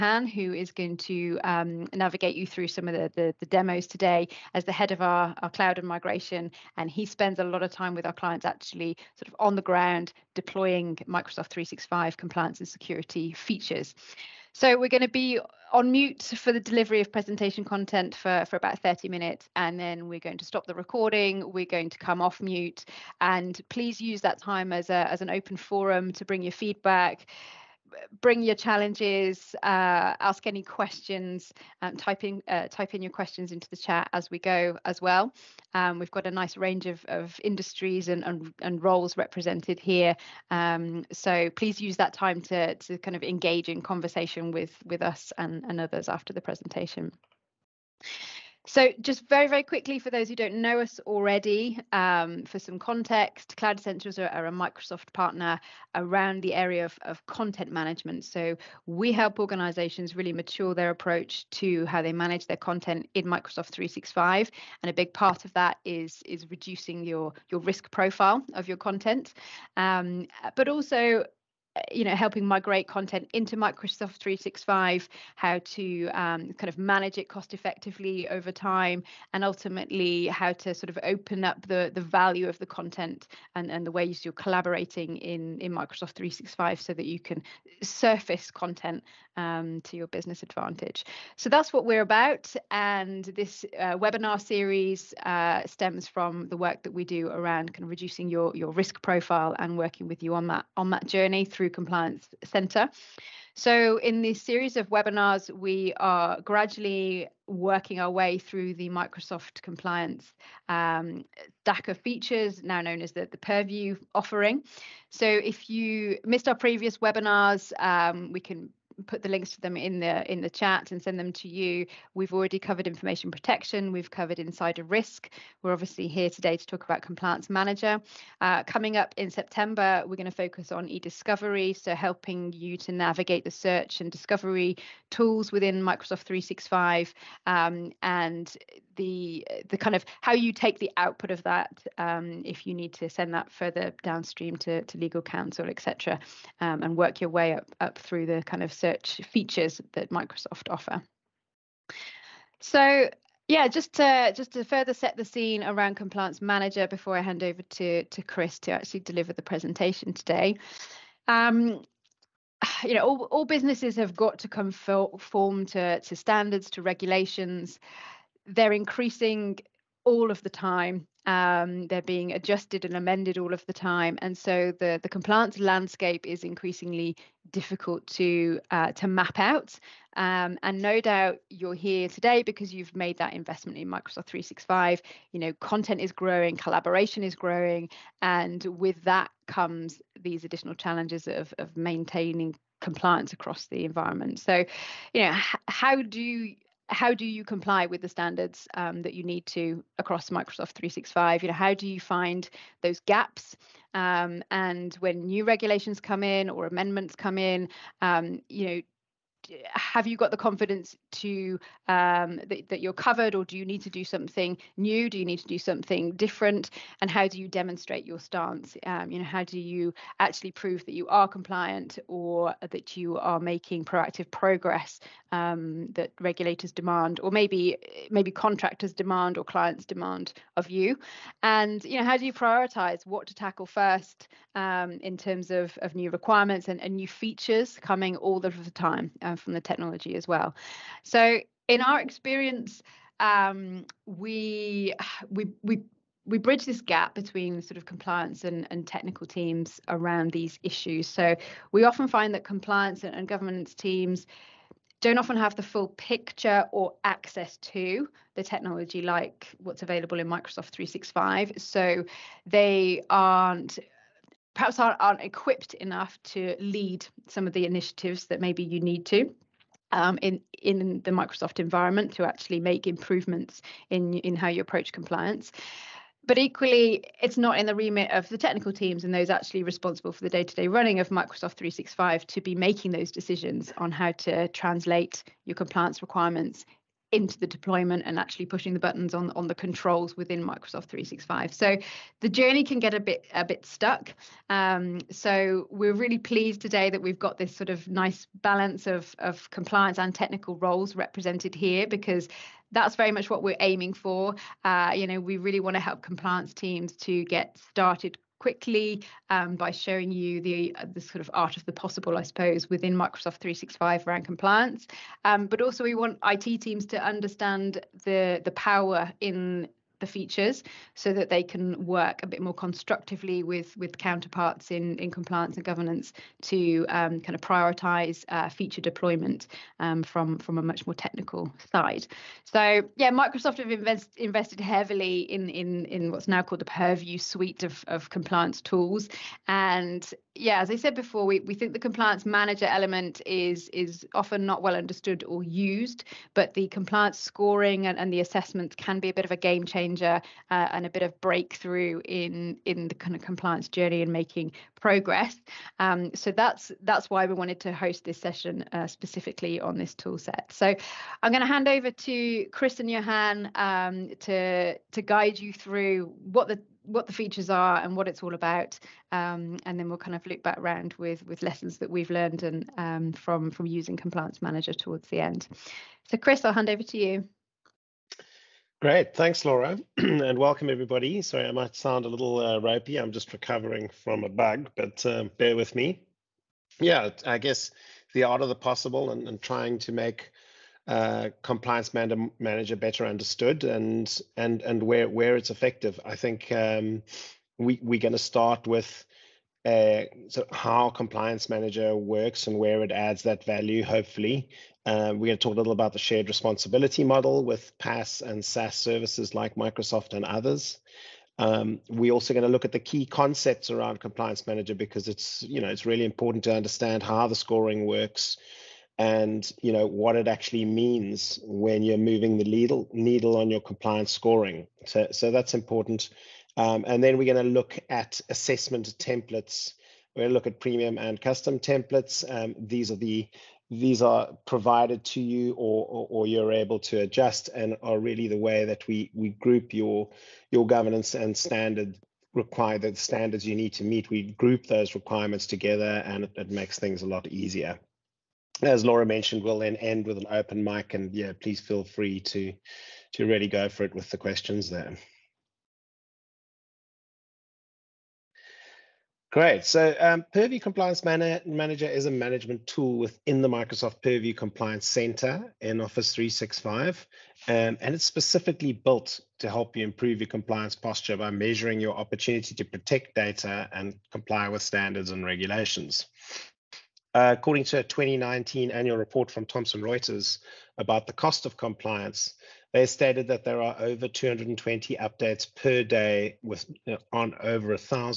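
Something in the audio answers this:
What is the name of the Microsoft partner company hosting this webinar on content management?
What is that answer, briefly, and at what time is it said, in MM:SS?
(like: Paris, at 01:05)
Cloud Essentials, at 00:53.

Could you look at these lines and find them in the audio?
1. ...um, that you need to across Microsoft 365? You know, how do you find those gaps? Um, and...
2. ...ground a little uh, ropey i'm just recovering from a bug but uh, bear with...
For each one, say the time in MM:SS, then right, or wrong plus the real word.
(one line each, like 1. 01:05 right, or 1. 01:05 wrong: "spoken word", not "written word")
1. 03:18 right
2. 06:21 wrong: "sound", not "ground".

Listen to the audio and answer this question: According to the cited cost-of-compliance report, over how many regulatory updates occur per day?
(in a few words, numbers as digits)
220.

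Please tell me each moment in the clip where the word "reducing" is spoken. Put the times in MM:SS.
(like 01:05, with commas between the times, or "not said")
01:06, 01:37.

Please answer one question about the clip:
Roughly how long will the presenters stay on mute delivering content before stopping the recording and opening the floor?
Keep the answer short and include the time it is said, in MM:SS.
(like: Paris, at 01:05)
30 minutes, at 00:18.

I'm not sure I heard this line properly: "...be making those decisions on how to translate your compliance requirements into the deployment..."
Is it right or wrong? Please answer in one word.
right.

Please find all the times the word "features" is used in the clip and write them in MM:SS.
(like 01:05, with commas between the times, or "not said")
00:13, 01:51, 02:29, 03:57, 05:20, 05:28, 06:07.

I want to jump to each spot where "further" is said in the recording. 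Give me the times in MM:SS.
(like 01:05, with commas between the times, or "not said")
02:23, 02:34.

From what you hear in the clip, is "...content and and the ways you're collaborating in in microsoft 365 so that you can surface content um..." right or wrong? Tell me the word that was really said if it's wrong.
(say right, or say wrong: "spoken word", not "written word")
right.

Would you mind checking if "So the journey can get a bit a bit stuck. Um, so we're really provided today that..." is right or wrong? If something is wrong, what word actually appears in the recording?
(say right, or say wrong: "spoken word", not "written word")
wrong: "pleased", not "provided".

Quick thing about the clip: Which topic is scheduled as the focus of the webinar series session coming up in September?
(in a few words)
e-discovery.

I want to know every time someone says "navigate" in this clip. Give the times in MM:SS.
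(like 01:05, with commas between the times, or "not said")
00:01, 02:12.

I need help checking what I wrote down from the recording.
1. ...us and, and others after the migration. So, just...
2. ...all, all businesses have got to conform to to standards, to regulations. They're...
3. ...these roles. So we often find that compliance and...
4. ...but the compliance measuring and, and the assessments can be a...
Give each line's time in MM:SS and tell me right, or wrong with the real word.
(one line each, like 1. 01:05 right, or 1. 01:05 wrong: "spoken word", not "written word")
1. 00:45 wrong: "presentation", not "migration"
2. 02:43 right
3. 04:10 wrong: "issues", not "roles"
4. 05:46 wrong: "scoring", not "measuring".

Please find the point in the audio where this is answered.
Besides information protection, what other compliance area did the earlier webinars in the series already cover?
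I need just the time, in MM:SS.
02:04.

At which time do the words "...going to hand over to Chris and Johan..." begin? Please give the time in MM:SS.
06:01.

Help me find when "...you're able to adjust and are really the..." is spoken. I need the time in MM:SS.
07:16.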